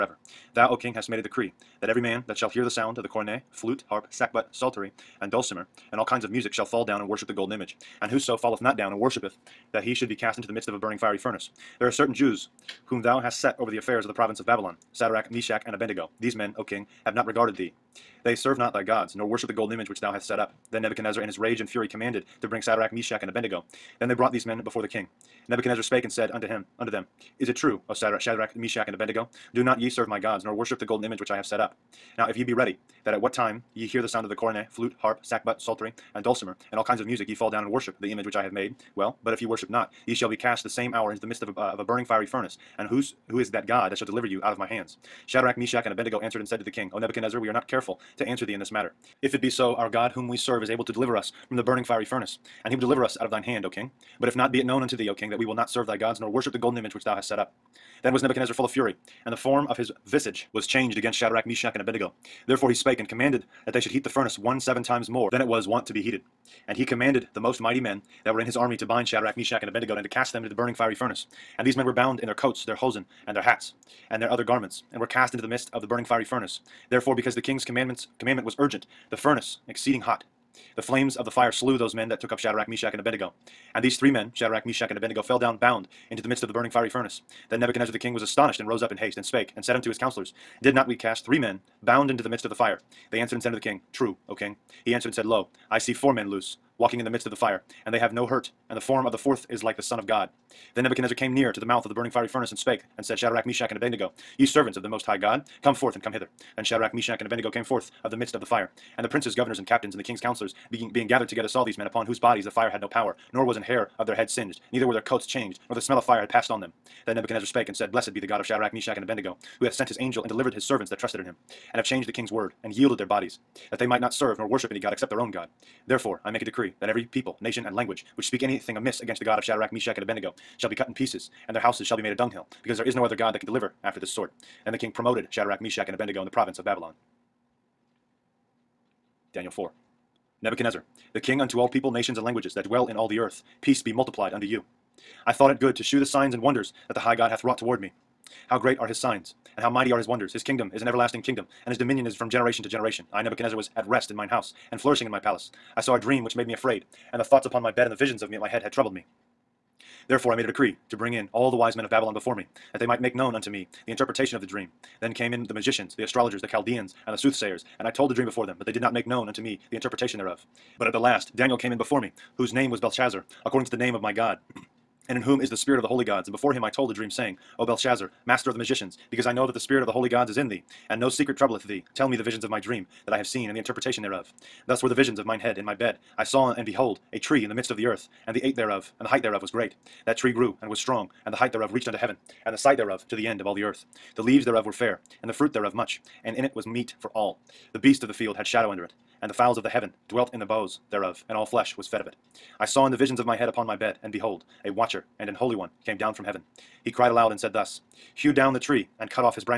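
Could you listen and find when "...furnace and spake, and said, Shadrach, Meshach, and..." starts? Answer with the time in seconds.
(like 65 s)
102 s.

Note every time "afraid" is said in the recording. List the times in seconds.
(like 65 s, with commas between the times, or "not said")
156 s.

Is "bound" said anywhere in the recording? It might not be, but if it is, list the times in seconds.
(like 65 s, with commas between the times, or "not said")
71 s, 85 s, 91 s.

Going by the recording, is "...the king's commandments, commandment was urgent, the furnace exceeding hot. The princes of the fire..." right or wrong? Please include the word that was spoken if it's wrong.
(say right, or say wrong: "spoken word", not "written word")
wrong: "flames", not "princes".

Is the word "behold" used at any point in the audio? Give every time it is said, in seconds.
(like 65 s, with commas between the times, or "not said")
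186 s, 204 s.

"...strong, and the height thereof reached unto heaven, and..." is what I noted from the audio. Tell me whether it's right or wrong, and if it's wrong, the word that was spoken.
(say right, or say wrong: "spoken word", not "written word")
right.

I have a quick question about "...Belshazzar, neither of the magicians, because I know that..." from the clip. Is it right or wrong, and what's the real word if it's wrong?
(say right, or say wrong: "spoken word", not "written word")
wrong: "master", not "neither".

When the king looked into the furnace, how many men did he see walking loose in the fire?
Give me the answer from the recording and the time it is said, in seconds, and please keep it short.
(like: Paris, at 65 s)
4, at 95 s.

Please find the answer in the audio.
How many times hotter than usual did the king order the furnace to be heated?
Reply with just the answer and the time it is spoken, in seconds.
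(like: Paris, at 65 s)
7, at 64 s.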